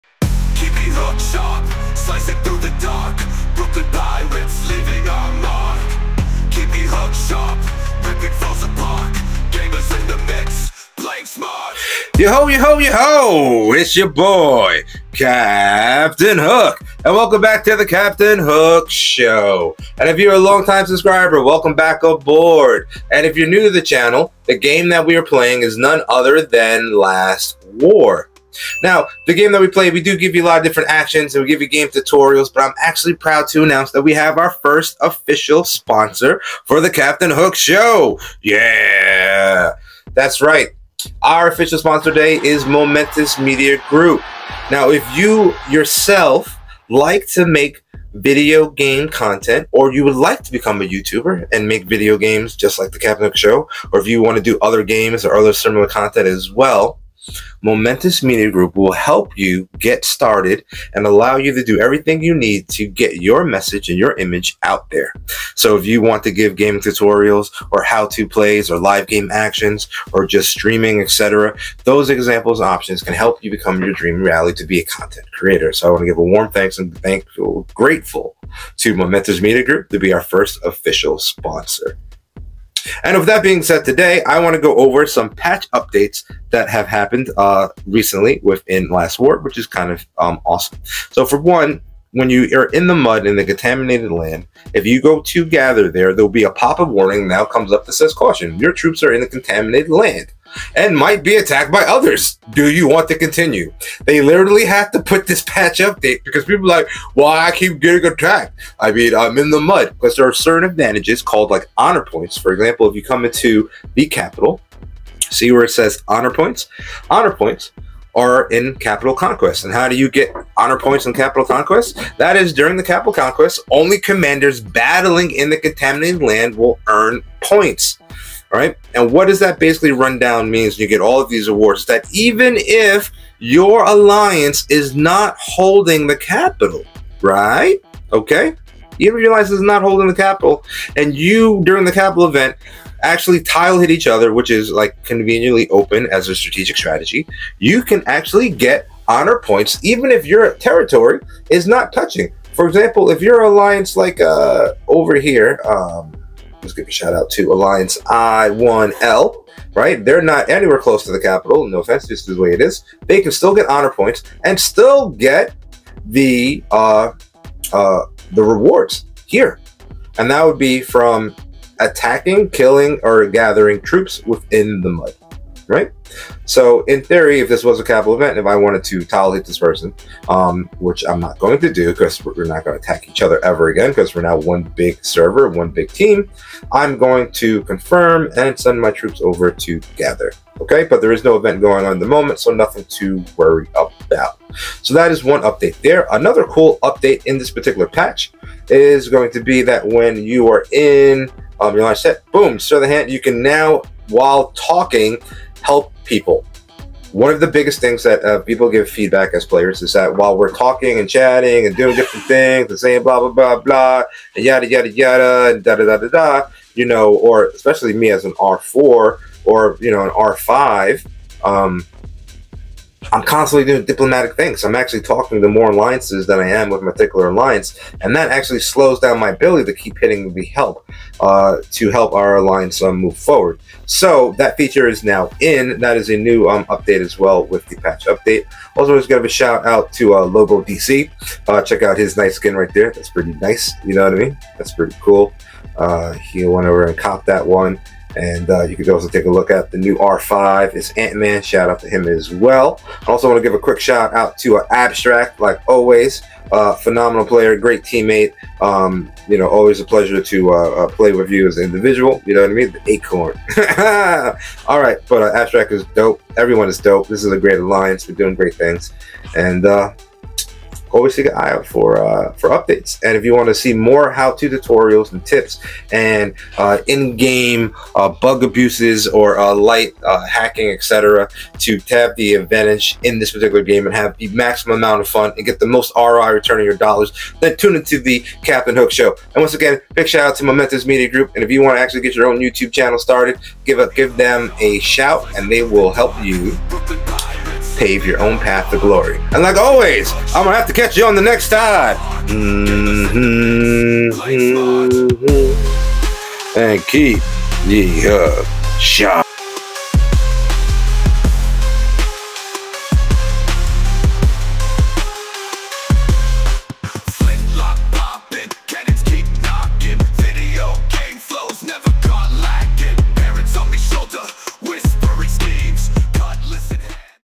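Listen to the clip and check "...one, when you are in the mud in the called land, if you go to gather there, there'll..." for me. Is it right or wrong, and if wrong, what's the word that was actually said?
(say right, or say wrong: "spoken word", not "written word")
wrong: "contaminated", not "called".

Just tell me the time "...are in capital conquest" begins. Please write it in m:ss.
1:58.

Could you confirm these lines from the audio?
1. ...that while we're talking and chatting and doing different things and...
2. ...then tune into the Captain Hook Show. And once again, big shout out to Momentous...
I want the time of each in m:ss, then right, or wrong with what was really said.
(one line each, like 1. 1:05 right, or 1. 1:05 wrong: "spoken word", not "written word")
1. 3:29 right
2. 4:47 right.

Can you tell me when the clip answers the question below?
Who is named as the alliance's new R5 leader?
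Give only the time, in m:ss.
4:10.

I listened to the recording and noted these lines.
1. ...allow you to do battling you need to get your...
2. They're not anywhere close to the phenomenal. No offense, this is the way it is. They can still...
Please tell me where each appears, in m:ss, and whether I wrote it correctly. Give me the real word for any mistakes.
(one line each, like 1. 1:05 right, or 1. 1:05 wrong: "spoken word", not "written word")
1. 1:01 wrong: "everything", not "battling"
2. 2:40 wrong: "capital", not "phenomenal".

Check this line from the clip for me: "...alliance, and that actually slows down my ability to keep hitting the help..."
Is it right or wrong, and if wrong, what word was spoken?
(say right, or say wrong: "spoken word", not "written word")
right.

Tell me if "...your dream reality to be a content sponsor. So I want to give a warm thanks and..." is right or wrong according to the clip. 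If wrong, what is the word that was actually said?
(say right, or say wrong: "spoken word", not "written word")
wrong: "creator", not "sponsor".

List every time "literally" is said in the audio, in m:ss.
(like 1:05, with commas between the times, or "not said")
1:44.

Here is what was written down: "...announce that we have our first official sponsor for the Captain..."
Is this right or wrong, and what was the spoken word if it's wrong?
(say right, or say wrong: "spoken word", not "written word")
right.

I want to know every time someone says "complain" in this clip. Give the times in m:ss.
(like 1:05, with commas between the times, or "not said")
not said.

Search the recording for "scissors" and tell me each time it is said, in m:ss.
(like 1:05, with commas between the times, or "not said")
not said.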